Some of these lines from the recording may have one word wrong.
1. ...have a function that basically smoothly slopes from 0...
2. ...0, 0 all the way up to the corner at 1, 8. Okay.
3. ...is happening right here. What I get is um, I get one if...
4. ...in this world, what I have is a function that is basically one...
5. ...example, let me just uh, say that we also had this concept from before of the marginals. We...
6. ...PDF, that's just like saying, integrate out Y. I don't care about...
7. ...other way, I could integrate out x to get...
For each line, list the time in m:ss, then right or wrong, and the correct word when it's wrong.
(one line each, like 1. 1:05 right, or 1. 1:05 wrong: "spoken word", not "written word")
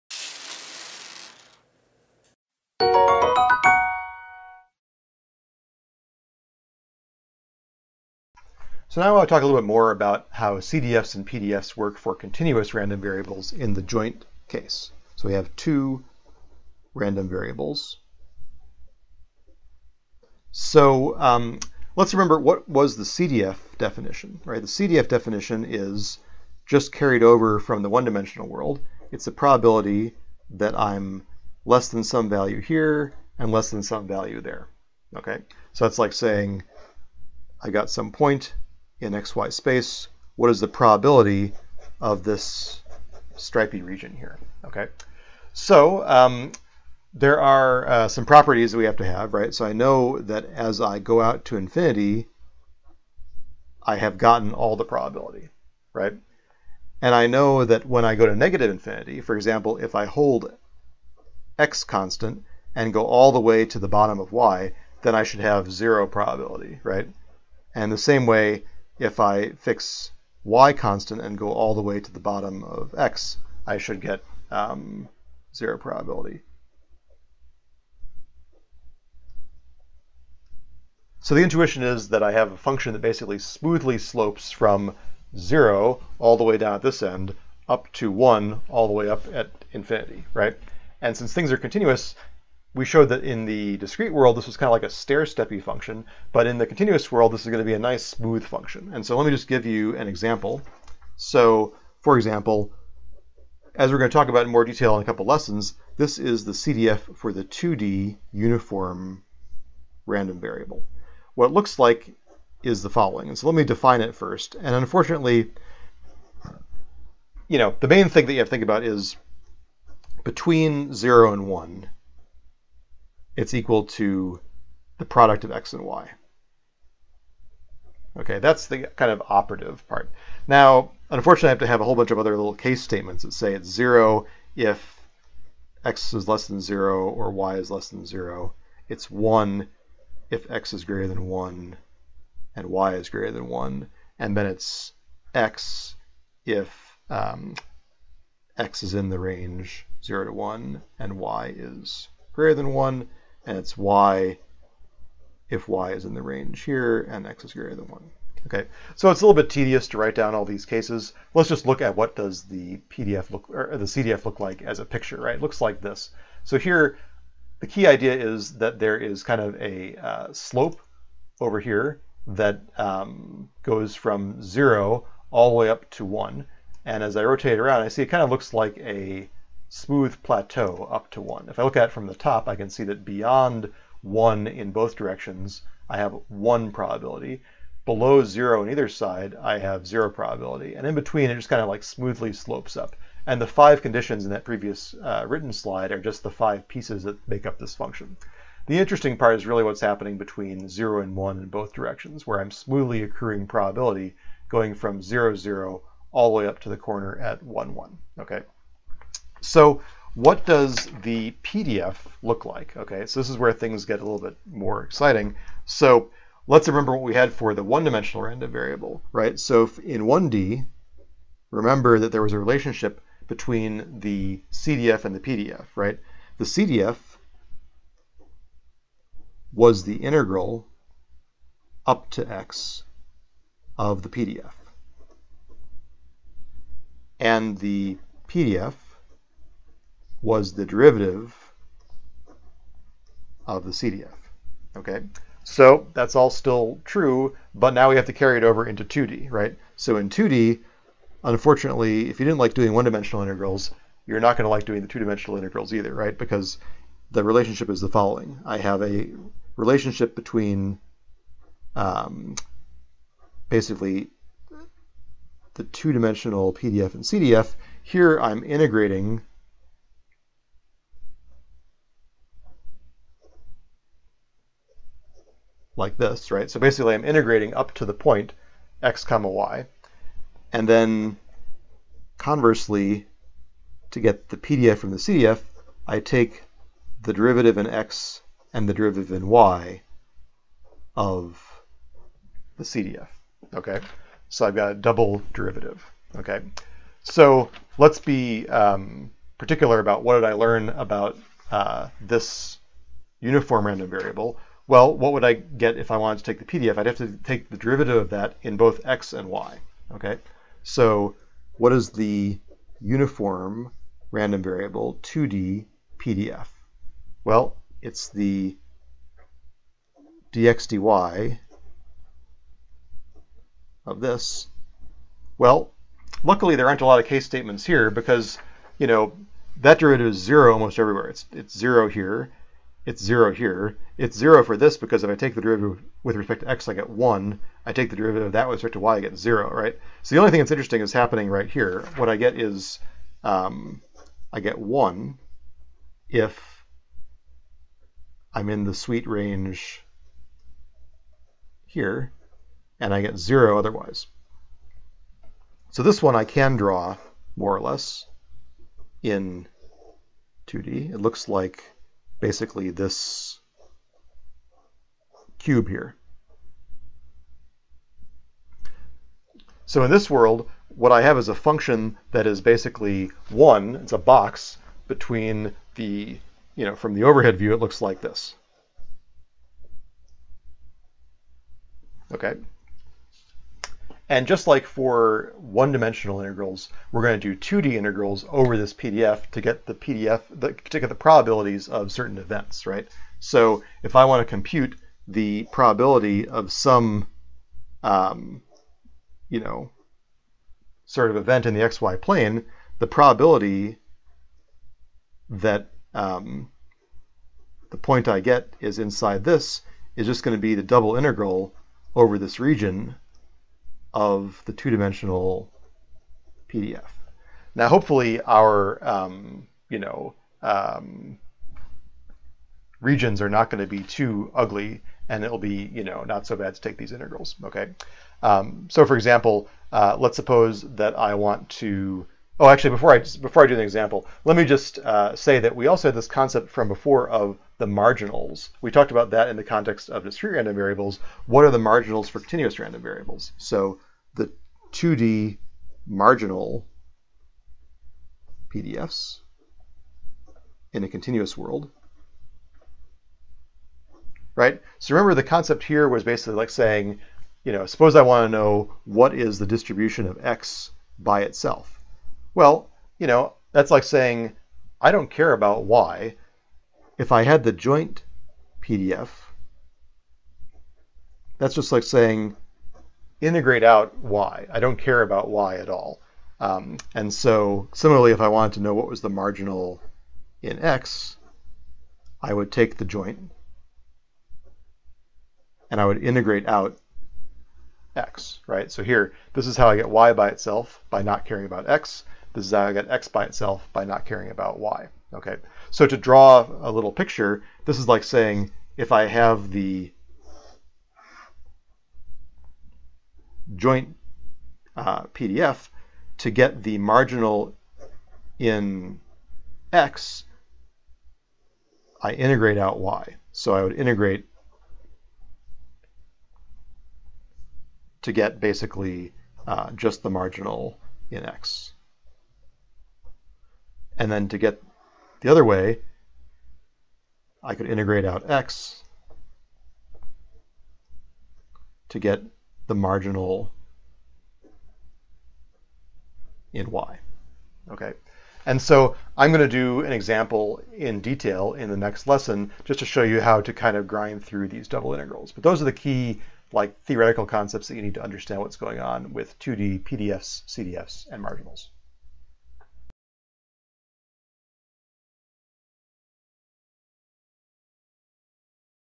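1. 1:22 right
2. 3:25 wrong: "1", not "8"
3. 5:40 right
4. 6:09 right
5. 7:13 right
6. 7:48 right
7. 8:45 right.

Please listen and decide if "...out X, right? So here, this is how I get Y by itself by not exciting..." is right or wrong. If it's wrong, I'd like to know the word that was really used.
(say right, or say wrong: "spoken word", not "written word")
wrong: "caring", not "exciting".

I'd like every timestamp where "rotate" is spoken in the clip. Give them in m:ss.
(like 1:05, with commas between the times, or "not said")
2:57.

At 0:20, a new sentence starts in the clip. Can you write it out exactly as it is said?
So um, let's remember what was the CDF definition, right?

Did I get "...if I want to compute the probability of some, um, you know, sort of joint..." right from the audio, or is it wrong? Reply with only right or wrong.
wrong.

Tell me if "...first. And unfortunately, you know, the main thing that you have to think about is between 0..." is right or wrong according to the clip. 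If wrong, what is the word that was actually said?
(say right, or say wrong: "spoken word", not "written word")
right.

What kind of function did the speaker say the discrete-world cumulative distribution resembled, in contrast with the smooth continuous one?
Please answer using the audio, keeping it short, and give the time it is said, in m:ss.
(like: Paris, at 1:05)
stair-steppy, at 1:34.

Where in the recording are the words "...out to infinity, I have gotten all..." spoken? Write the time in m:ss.
0:51.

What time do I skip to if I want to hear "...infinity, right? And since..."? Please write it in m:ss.
1:29.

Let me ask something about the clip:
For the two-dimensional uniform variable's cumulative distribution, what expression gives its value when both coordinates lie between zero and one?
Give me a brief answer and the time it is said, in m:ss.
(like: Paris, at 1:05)
product of x and y, at 2:05.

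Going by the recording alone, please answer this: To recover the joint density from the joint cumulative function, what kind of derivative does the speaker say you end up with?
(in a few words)
double derivative.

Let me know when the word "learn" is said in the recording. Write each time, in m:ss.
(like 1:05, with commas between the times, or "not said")
5:00.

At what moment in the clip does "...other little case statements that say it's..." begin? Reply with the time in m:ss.
2:12.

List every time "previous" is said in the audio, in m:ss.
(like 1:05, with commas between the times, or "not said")
3:14.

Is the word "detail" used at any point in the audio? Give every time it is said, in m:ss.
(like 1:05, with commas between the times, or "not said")
1:44, 9:01.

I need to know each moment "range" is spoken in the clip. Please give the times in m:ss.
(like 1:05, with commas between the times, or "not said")
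2:29, 2:36, 5:49.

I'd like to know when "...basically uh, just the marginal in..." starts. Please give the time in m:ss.
8:38.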